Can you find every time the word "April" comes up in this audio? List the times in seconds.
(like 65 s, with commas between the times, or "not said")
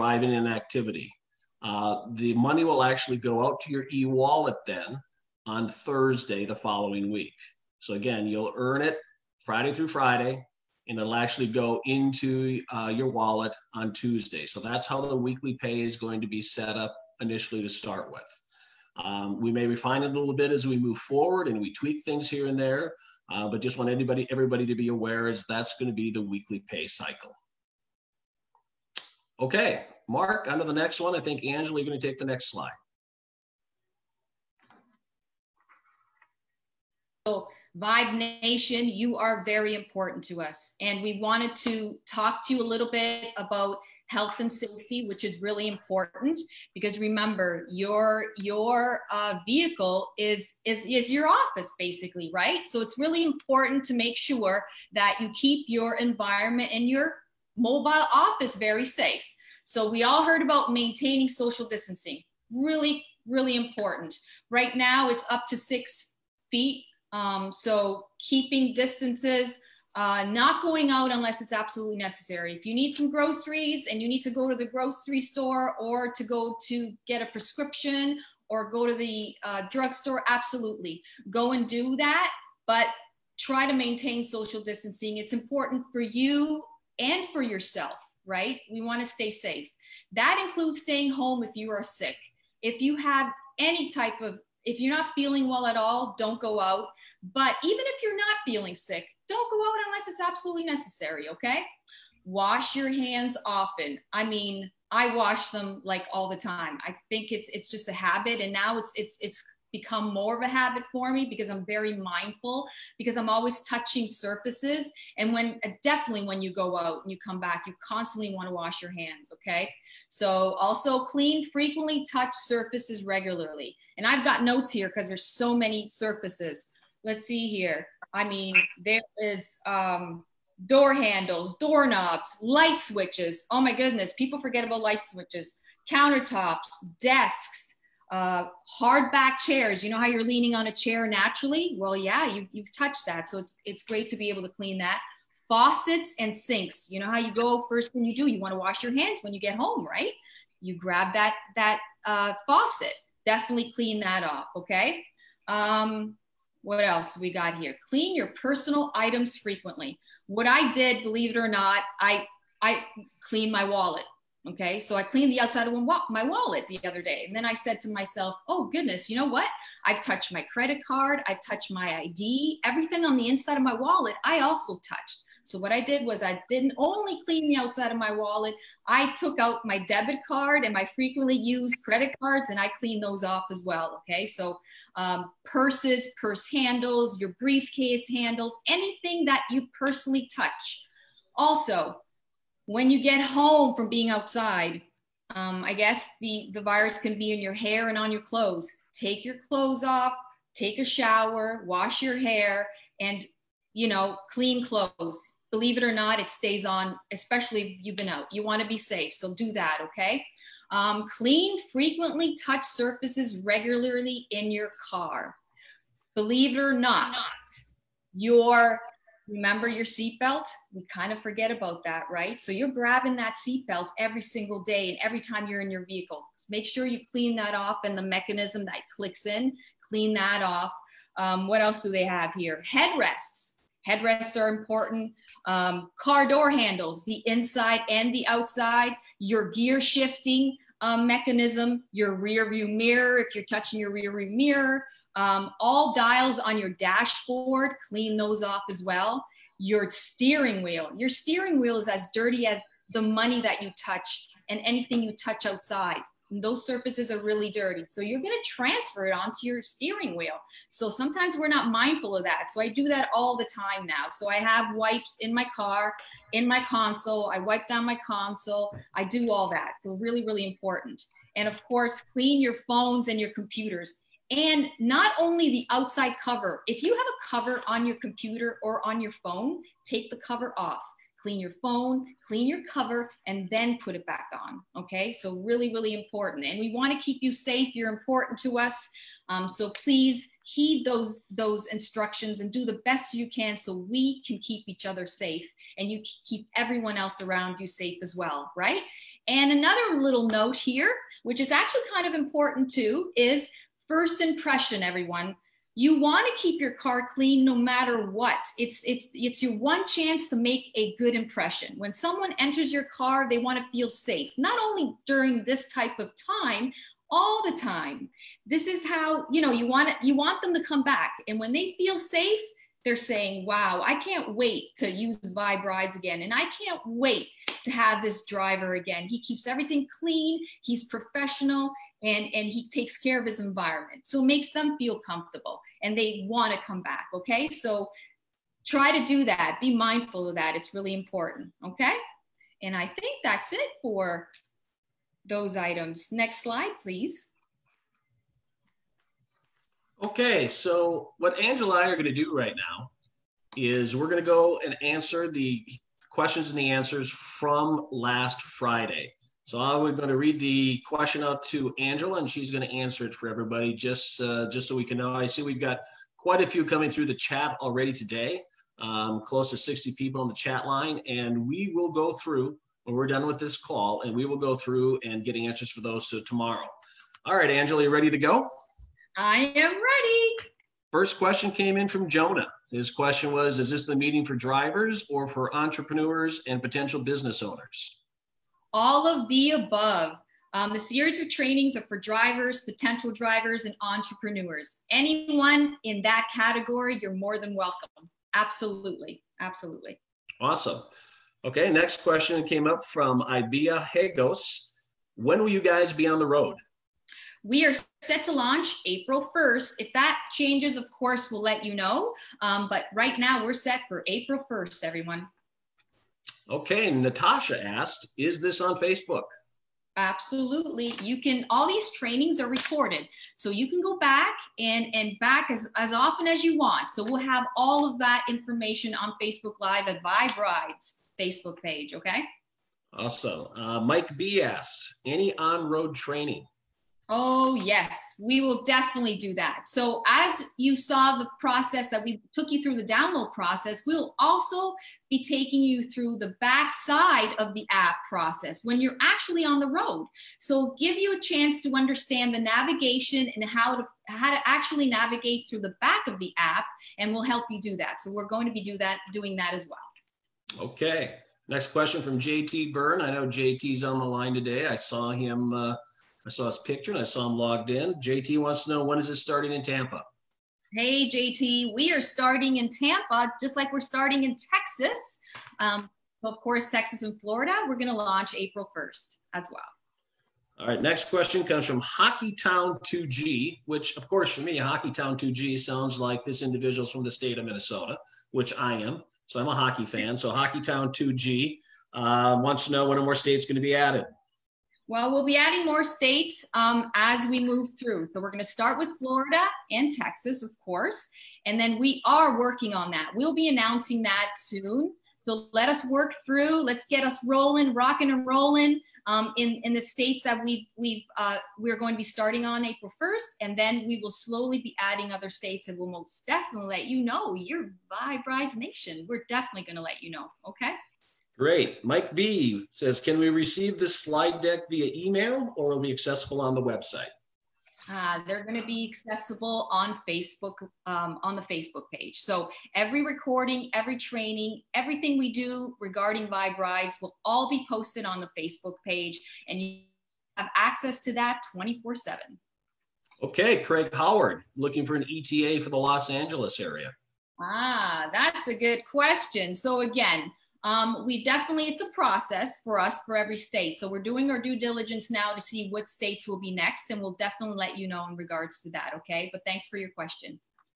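408 s, 414 s, 478 s, 512 s.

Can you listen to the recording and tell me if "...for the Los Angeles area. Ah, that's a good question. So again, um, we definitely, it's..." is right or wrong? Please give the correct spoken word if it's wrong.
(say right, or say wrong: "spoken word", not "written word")
right.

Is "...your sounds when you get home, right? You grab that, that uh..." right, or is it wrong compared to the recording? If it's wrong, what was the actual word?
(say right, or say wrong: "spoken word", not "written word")
wrong: "hands", not "sounds".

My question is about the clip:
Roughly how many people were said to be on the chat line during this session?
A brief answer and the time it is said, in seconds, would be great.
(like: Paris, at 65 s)
60, at 369 s.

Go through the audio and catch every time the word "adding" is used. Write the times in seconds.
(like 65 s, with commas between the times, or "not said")
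495 s, 514 s.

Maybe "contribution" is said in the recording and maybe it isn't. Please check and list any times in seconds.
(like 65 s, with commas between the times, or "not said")
not said.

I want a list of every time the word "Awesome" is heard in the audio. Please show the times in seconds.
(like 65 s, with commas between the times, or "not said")
400 s, 432 s.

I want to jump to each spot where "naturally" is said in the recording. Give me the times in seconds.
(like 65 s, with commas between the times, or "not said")
141 s.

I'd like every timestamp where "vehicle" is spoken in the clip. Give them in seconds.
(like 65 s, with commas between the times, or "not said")
49 s, 225 s.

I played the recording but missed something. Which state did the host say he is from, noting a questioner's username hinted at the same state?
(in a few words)
Minnesota.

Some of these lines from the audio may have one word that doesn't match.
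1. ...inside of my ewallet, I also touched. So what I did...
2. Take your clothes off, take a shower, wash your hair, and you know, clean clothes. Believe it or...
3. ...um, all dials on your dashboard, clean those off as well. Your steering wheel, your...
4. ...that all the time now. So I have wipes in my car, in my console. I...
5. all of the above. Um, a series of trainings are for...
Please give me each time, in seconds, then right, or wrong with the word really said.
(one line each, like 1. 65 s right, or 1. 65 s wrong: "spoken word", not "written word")
1. 173 s wrong: "wallet", not "ewallet"
2. 198 s right
3. 245 s right
4. 262 s right
5. 388 s right.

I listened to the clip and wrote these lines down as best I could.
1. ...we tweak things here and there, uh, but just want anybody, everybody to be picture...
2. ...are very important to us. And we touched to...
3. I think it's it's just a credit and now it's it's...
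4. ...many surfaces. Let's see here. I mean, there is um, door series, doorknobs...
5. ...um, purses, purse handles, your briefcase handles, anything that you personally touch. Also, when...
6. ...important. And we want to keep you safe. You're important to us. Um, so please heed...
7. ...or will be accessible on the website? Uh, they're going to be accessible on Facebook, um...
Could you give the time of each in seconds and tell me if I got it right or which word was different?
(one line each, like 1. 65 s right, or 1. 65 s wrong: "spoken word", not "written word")
1. 21 s wrong: "aware", not "picture"
2. 39 s wrong: "wanted", not "touched"
3. 106 s wrong: "habit", not "credit"
4. 125 s wrong: "handles", not "series"
5. 184 s right
6. 285 s right
7. 525 s right.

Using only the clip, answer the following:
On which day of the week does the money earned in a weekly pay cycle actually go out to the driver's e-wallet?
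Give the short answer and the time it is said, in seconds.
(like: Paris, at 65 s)
Thursday, at 5 s.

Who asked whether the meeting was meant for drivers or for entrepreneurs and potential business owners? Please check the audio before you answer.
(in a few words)
Jonah.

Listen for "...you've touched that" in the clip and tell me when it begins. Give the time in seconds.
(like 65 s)
142 s.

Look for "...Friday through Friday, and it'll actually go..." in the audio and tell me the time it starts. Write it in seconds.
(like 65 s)
9 s.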